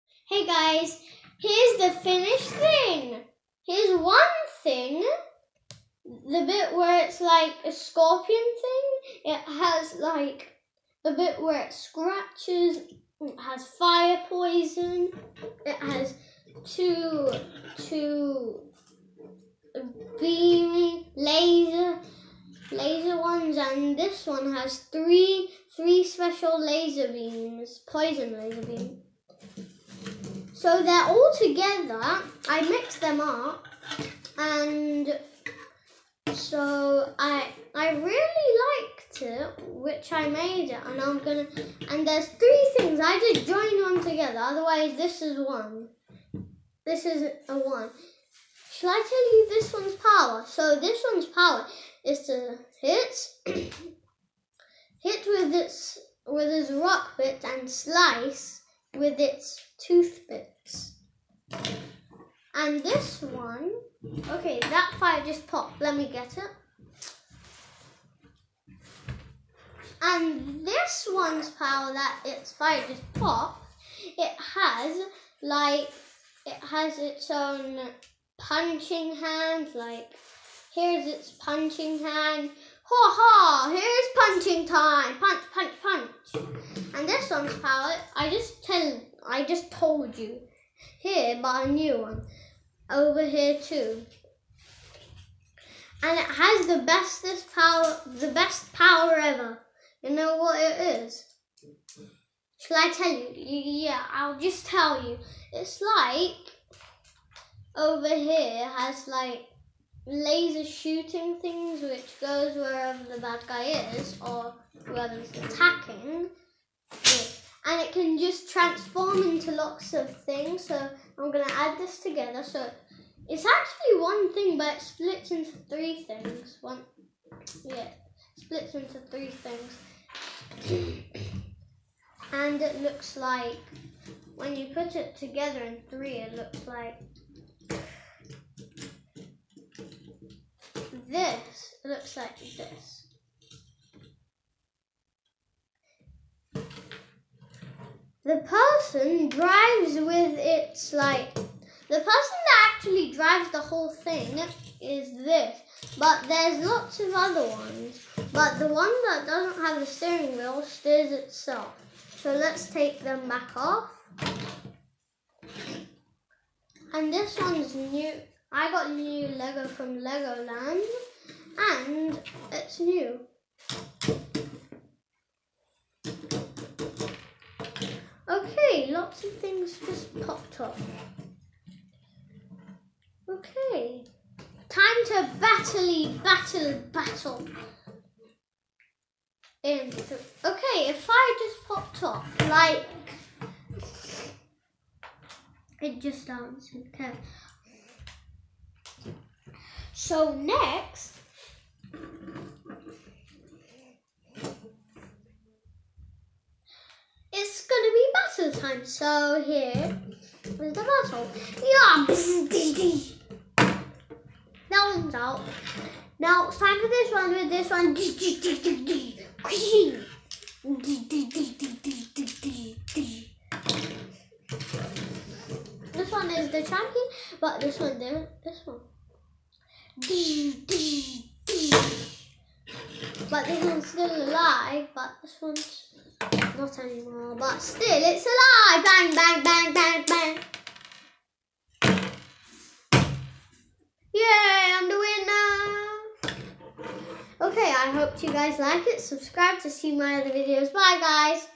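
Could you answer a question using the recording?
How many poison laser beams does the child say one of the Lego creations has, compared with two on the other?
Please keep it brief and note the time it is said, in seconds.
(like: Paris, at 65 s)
3, at 24 s.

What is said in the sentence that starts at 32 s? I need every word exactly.
I mixed them up and so I I really liked it, which I made it, and I'm gonna.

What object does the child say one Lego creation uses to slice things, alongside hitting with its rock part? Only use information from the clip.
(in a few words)
toothpicks.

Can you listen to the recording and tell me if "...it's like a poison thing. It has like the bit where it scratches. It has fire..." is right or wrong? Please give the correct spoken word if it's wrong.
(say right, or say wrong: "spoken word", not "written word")
wrong: "scorpion", not "poison".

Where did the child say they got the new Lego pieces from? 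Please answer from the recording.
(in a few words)
Legoland.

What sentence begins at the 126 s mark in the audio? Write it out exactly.
One, yeah, splits into three things.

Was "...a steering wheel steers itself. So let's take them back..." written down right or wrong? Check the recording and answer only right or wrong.
right.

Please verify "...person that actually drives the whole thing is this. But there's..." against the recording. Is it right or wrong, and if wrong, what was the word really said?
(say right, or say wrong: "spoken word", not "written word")
right.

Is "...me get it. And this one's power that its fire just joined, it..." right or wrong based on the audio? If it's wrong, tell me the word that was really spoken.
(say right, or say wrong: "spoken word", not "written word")
wrong: "popped", not "joined".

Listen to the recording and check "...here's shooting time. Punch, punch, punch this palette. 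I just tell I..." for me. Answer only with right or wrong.
wrong.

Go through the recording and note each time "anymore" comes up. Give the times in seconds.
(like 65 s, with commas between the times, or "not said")
236 s.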